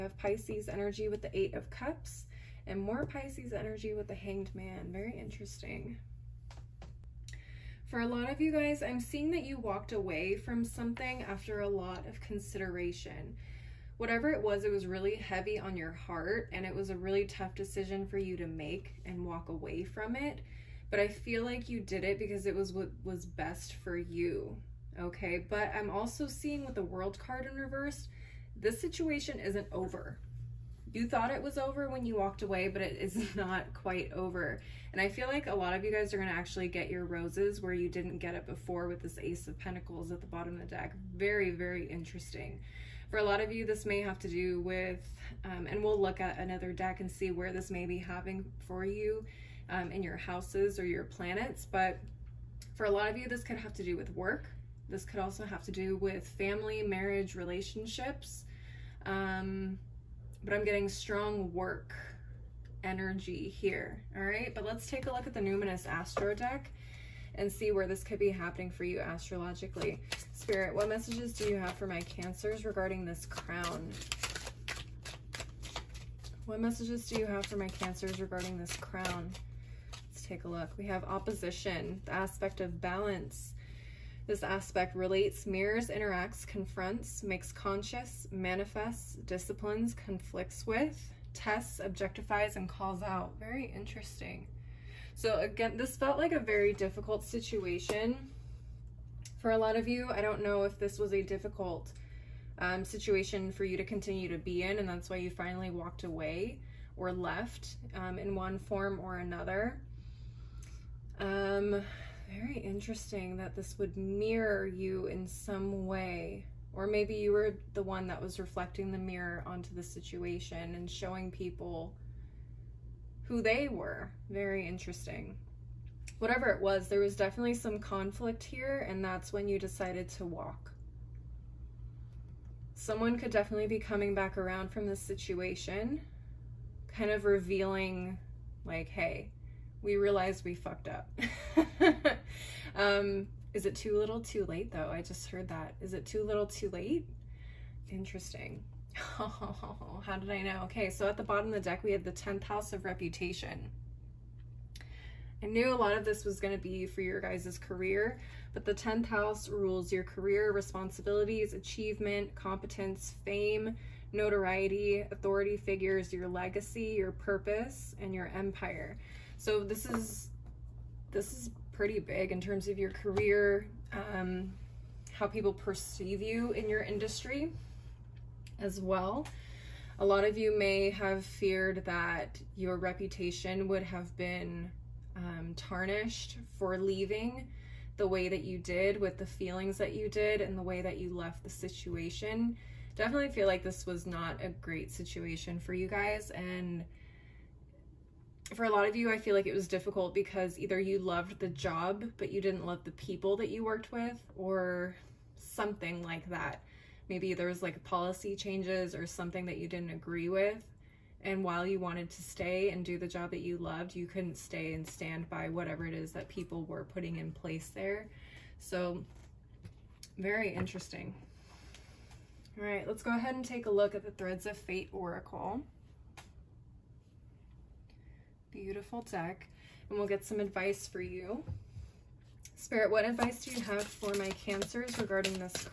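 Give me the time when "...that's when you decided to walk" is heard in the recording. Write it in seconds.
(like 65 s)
129 s.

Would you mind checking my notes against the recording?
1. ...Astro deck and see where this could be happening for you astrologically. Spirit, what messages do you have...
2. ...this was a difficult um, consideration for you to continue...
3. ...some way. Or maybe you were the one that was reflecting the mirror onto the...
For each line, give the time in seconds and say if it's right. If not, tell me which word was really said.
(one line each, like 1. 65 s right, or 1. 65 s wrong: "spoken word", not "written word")
1. 65 s right
2. 100 s wrong: "situation", not "consideration"
3. 115 s right.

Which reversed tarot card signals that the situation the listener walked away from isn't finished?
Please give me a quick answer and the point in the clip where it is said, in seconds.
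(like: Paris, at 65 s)
The World, at 26 s.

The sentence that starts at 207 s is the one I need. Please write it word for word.
Maybe there was like policy changes or something that you didn't agree with.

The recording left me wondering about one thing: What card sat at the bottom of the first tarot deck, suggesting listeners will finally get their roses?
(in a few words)
Ace of Pentacles.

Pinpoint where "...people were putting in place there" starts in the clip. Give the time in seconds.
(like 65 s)
216 s.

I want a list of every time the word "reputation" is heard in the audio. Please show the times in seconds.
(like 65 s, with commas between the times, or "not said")
152 s, 182 s.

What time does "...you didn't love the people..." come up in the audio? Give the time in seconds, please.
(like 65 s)
202 s.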